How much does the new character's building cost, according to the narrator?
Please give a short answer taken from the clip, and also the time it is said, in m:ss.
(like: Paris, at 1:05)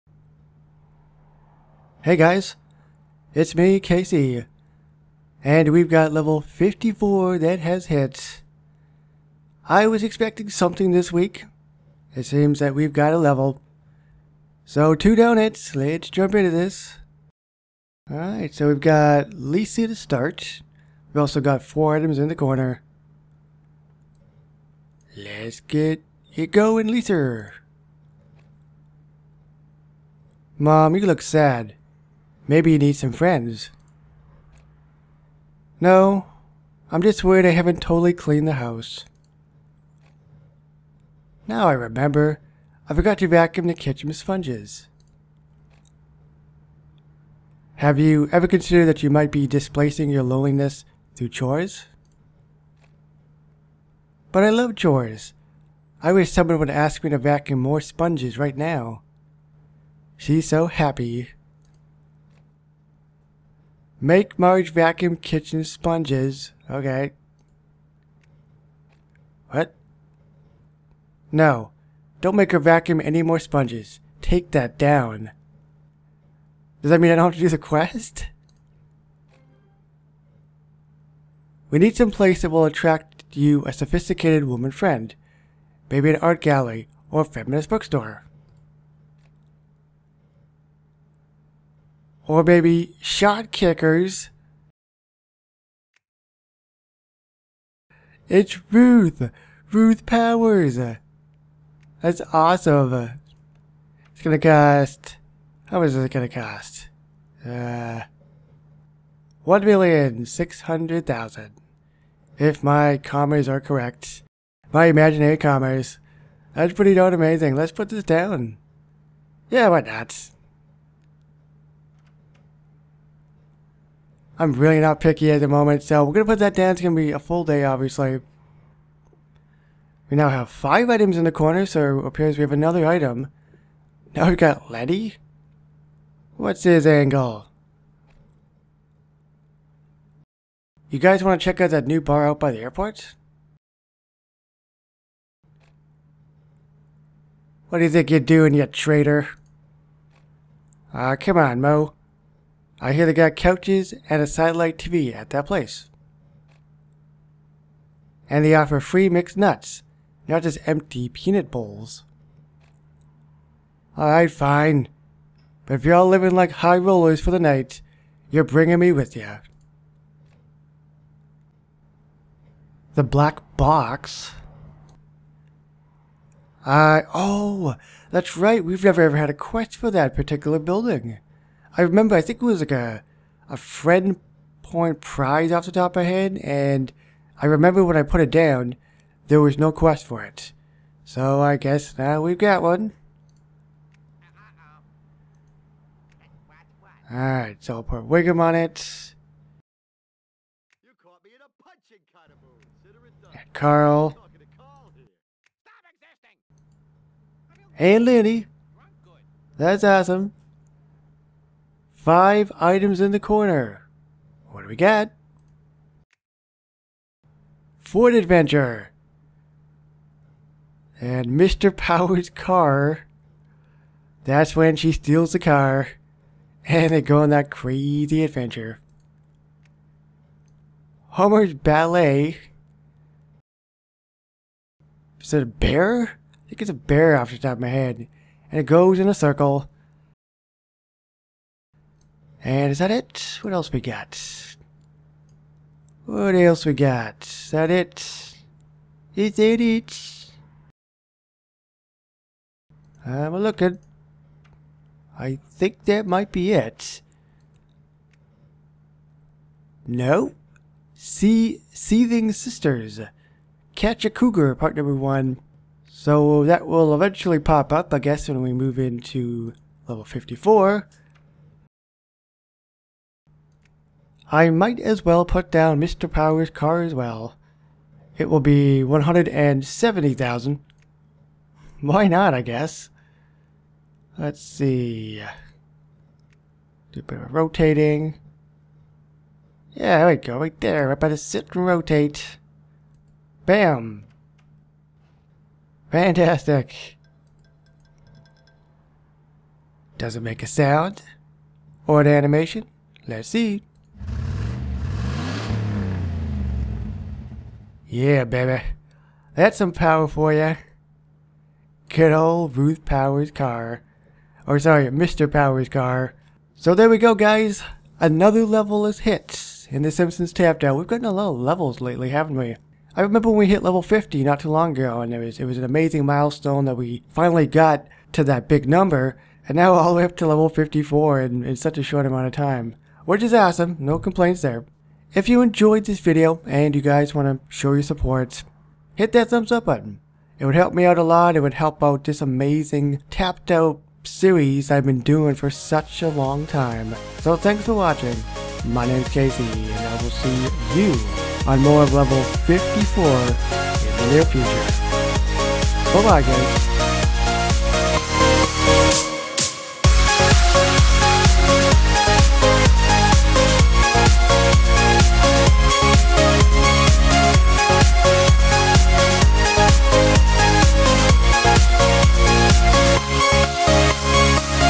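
1,600,000, at 1:49.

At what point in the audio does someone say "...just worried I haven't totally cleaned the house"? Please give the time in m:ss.
0:37.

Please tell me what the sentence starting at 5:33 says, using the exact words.
Which is awesome, no complaints there.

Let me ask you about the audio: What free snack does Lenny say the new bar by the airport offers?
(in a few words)
Mixed nuts.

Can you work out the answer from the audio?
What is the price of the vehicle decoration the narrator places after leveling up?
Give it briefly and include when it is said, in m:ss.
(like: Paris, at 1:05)
170,000, at 4:38.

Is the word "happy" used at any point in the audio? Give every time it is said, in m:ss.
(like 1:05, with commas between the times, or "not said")
1:00.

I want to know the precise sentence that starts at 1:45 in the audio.
How much is it gonna cost?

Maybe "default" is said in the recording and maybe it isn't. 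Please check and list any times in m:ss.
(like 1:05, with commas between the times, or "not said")
not said.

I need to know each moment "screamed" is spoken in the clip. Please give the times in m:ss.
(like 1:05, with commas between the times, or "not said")
not said.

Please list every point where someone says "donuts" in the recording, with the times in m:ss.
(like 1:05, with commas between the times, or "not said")
0:15.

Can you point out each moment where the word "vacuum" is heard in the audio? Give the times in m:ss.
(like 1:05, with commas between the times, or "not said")
0:43, 0:57, 1:04, 1:12.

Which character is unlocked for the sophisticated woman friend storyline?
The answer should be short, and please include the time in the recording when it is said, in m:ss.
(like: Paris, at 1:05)
Ruth Powers, at 1:39.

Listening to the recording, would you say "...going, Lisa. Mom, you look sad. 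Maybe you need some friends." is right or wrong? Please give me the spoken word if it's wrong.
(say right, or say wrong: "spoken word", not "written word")
right.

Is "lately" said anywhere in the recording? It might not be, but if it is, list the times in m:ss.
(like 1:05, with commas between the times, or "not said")
5:21.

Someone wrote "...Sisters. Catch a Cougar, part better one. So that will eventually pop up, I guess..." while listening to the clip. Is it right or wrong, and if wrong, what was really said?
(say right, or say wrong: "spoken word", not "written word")
wrong: "number", not "better".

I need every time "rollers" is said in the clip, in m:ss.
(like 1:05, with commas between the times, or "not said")
2:46.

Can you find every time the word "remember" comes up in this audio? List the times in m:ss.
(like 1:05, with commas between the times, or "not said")
0:41, 3:01, 3:07, 5:23.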